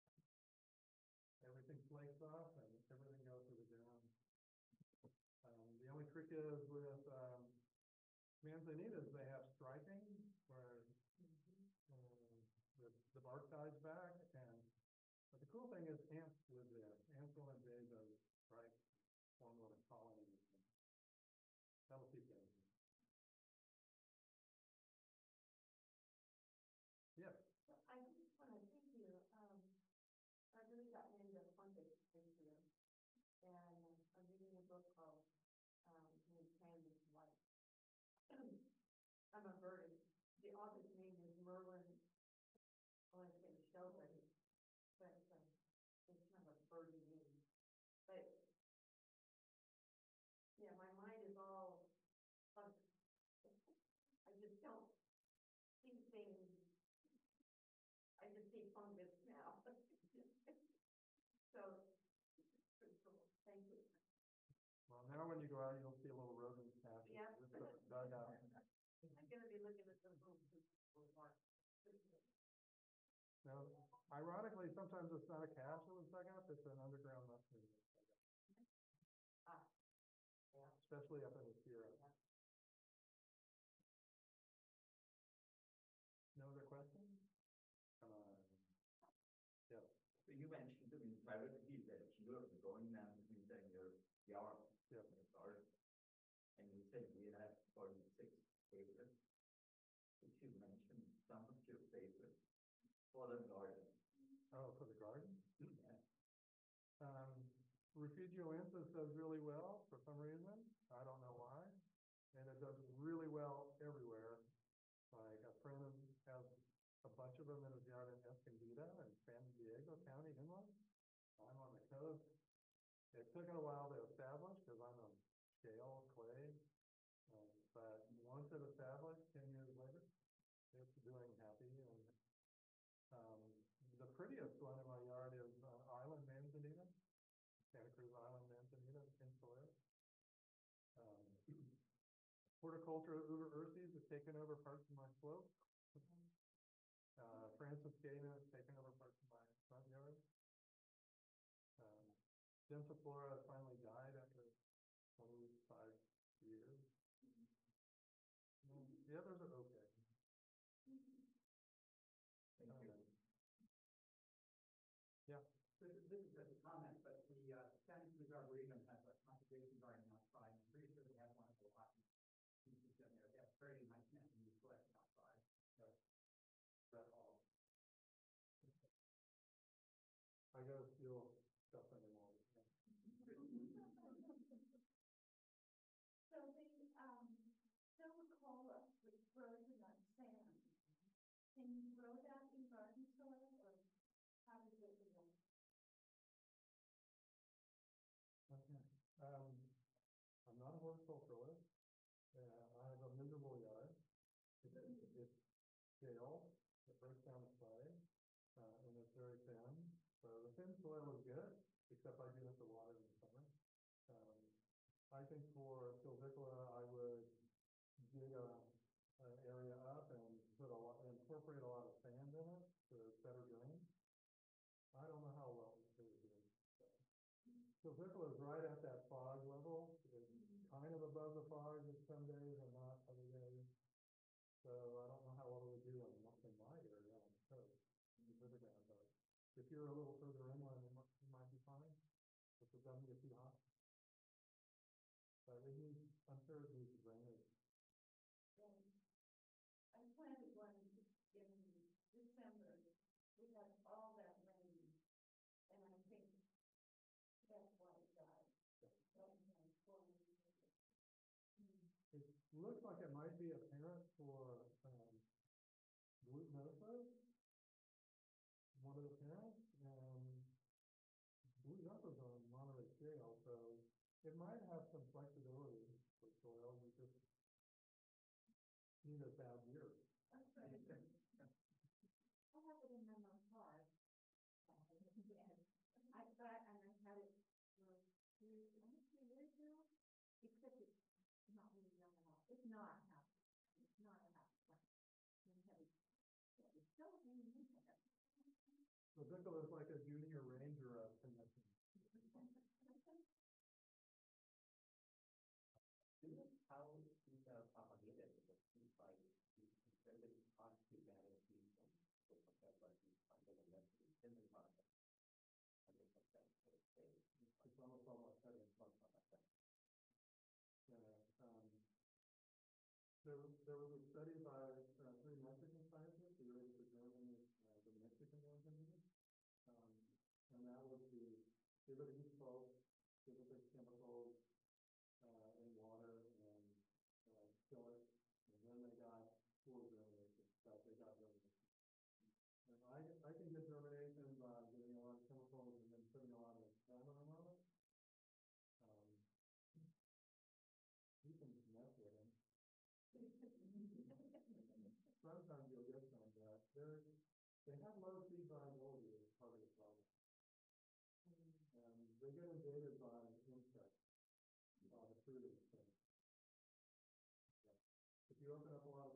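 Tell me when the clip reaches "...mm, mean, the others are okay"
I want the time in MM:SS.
02:38.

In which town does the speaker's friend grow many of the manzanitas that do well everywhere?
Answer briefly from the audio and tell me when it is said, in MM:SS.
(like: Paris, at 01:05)
Escondido, at 01:58.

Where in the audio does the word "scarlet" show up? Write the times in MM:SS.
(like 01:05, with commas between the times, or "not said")
not said.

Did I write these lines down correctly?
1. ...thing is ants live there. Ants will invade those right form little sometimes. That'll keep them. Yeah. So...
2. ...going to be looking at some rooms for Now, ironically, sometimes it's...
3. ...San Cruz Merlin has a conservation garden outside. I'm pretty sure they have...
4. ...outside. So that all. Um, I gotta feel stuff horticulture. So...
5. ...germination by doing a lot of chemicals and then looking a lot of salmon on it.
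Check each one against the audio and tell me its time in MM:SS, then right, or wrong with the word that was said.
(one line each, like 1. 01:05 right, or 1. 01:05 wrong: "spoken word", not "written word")
1. 00:15 wrong: "colonies", not "sometimes"
2. 01:09 right
3. 02:47 wrong: "Arboretum", not "Merlin"
4. 02:54 wrong: "anymore", not "horticulture"
5. 05:43 wrong: "putting", not "looking".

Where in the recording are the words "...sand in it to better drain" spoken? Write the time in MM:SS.
03:42.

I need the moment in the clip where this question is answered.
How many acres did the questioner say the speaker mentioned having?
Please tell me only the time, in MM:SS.
01:37.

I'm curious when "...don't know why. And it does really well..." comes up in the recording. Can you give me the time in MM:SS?
01:51.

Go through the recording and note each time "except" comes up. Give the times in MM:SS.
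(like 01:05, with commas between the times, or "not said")
03:31, 04:50.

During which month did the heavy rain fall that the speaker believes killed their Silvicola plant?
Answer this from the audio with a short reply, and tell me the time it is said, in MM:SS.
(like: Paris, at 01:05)
December, at 04:12.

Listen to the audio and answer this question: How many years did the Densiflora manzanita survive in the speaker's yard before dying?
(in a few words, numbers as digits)
25.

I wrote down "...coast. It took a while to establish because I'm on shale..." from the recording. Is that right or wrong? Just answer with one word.
right.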